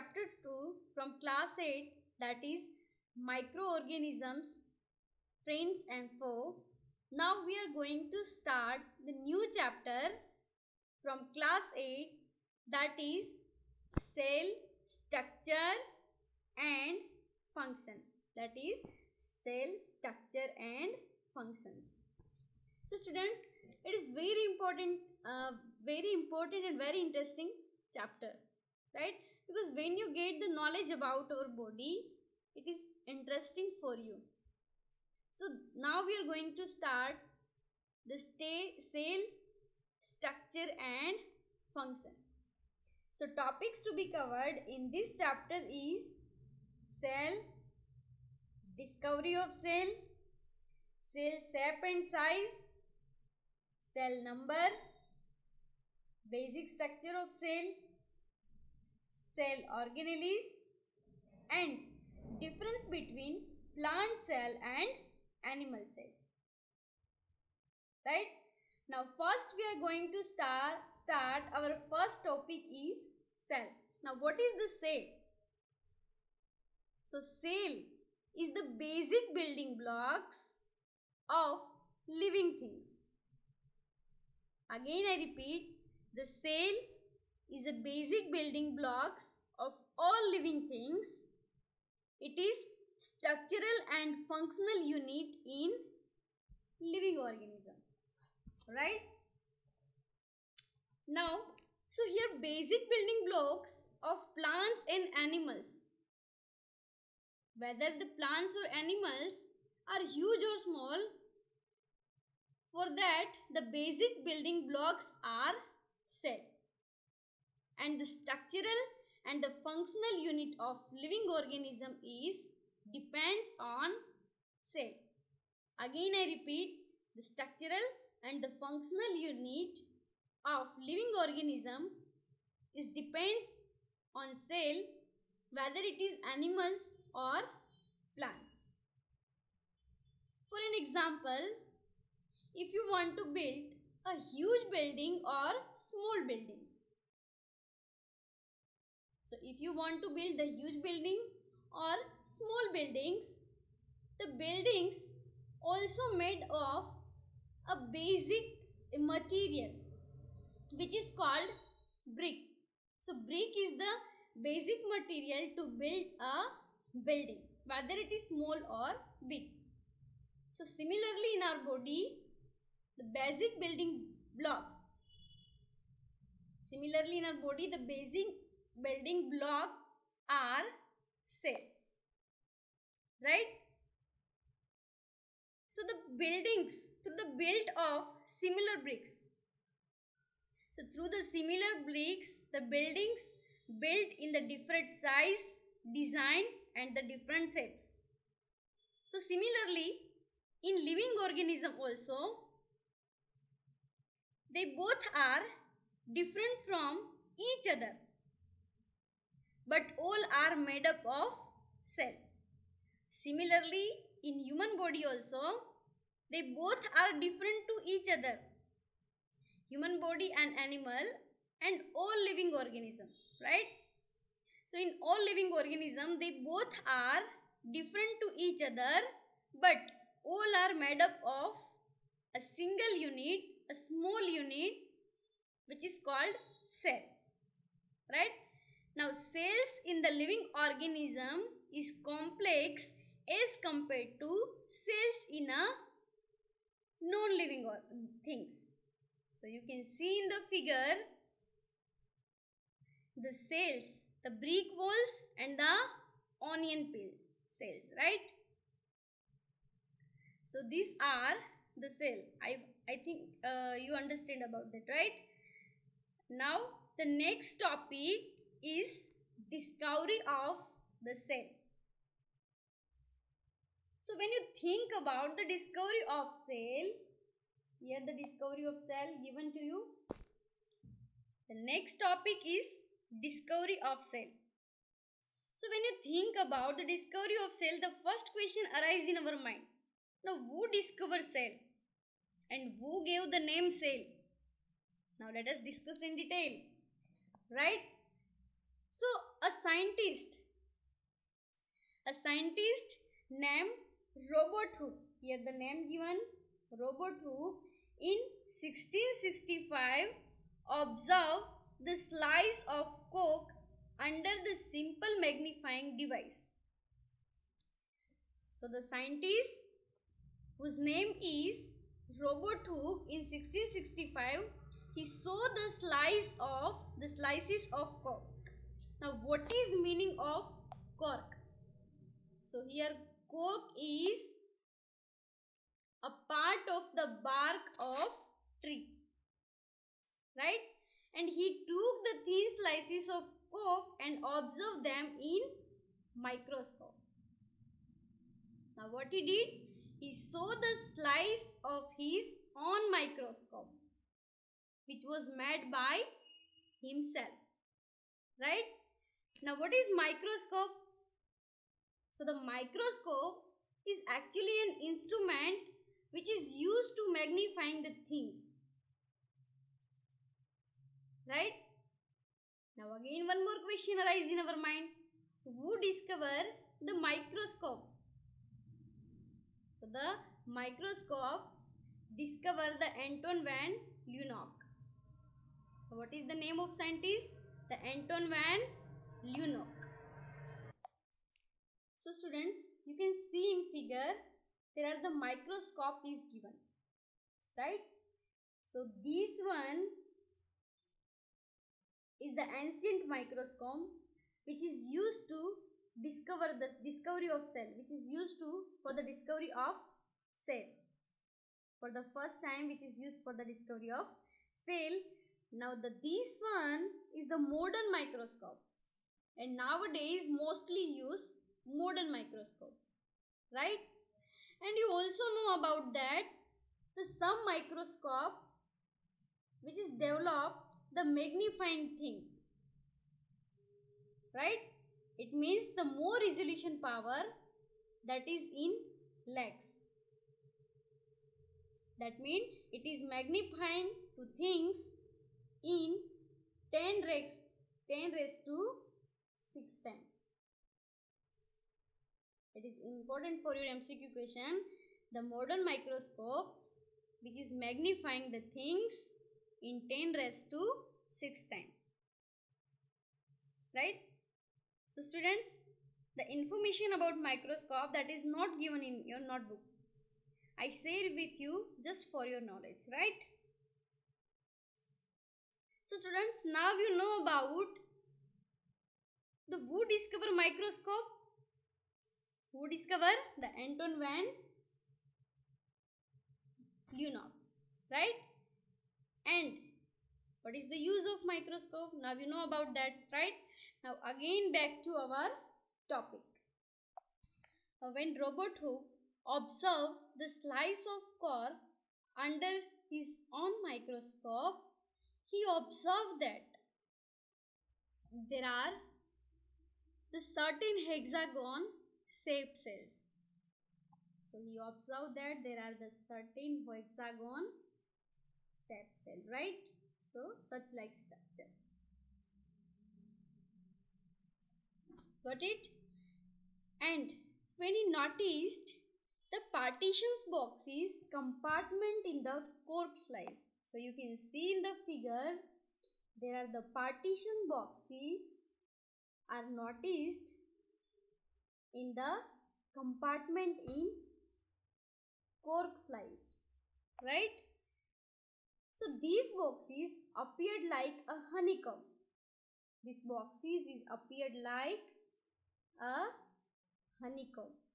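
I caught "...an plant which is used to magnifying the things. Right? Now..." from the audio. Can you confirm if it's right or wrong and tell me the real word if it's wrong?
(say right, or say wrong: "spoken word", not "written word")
wrong: "instrument", not "plant".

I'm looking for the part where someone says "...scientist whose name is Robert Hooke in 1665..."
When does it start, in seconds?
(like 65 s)
318 s.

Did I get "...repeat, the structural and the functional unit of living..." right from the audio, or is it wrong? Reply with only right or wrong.
right.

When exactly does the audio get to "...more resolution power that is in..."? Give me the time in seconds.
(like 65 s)
435 s.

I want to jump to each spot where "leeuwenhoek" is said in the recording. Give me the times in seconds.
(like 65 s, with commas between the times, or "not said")
384 s, 389 s, 486 s.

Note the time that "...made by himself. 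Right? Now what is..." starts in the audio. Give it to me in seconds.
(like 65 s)
355 s.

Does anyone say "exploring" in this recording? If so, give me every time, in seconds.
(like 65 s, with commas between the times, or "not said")
not said.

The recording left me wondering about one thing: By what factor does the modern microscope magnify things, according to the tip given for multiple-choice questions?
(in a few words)
10^6 times.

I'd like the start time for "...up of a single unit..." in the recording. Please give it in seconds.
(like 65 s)
231 s.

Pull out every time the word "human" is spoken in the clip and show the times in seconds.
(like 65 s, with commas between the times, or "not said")
214 s, 219 s.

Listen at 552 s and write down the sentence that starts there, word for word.
These boxes is appeared like a honeycomb.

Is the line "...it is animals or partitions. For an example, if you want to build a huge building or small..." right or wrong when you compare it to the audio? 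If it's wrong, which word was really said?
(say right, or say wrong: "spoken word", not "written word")
wrong: "plans", not "partitions".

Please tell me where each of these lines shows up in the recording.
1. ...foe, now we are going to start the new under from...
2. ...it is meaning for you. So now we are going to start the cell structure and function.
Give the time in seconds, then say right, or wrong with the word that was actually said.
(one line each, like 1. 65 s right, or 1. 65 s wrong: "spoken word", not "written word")
1. 6 s wrong: "chapter", not "under"
2. 32 s wrong: "interesting", not "meaning".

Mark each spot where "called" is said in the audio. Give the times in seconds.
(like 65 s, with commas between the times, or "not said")
161 s, 236 s.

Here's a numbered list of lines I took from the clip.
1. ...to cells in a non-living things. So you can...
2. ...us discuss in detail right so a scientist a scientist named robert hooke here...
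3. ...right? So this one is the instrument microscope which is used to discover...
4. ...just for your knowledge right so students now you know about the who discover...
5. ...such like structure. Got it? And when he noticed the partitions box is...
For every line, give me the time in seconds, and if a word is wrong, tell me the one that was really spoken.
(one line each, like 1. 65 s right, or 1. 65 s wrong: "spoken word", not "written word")
1. 244 s right
2. 295 s right
3. 397 s wrong: "ancient", not "instrument"
4. 471 s right
5. 520 s right.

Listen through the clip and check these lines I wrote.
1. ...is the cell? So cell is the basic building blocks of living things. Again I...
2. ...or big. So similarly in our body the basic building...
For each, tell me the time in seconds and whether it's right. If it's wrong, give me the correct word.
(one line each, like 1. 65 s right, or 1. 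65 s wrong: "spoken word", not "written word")
1. 74 s right
2. 168 s right.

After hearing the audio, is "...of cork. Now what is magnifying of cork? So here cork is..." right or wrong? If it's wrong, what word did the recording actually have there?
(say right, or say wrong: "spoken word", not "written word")
wrong: "meaning", not "magnifying".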